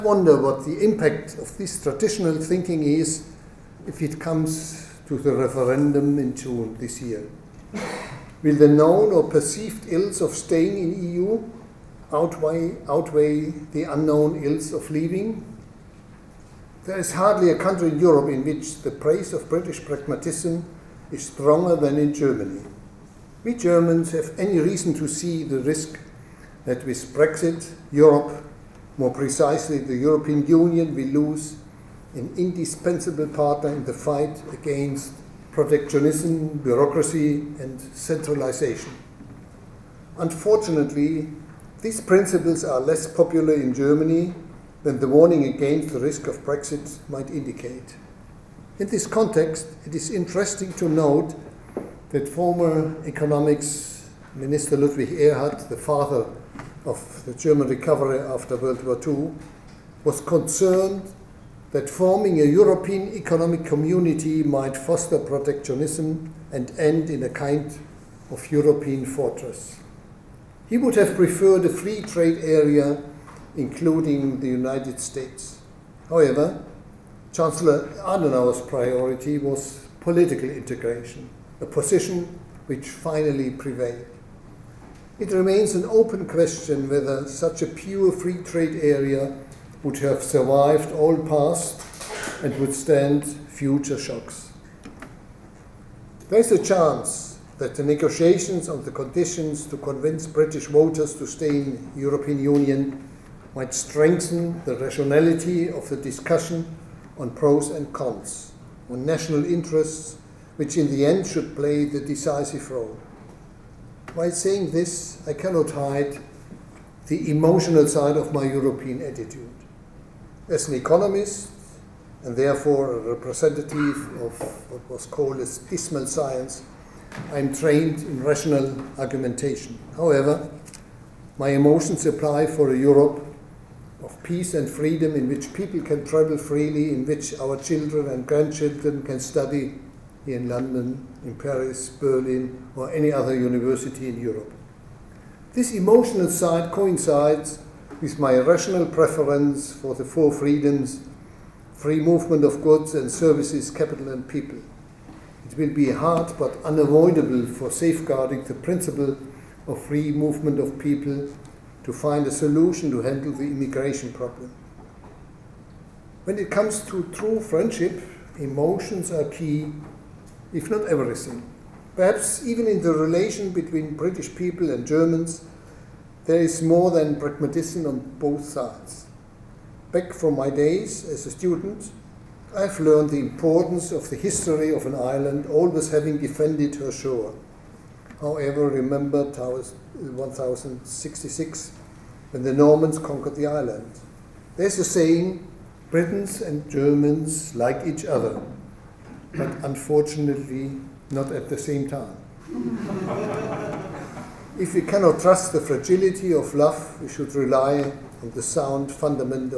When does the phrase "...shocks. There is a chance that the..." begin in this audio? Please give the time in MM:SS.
01:33.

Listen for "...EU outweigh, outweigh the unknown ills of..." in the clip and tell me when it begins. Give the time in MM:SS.
00:11.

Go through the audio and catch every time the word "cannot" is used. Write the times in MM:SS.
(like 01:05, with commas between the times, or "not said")
01:55, 03:24.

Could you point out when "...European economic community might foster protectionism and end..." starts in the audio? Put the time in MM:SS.
01:02.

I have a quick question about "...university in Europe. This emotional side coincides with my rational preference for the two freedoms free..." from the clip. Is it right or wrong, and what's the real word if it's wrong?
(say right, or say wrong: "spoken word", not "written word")
wrong: "four", not "two".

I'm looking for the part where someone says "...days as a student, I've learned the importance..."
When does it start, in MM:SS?
03:00.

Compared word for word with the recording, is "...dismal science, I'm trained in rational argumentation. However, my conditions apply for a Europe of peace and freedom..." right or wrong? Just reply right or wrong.
wrong.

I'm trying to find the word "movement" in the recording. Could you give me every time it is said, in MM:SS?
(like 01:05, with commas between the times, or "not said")
02:32, 02:40.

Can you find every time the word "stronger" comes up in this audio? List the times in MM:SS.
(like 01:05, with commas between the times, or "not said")
00:21.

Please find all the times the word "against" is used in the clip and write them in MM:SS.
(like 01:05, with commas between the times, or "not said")
00:34, 00:45.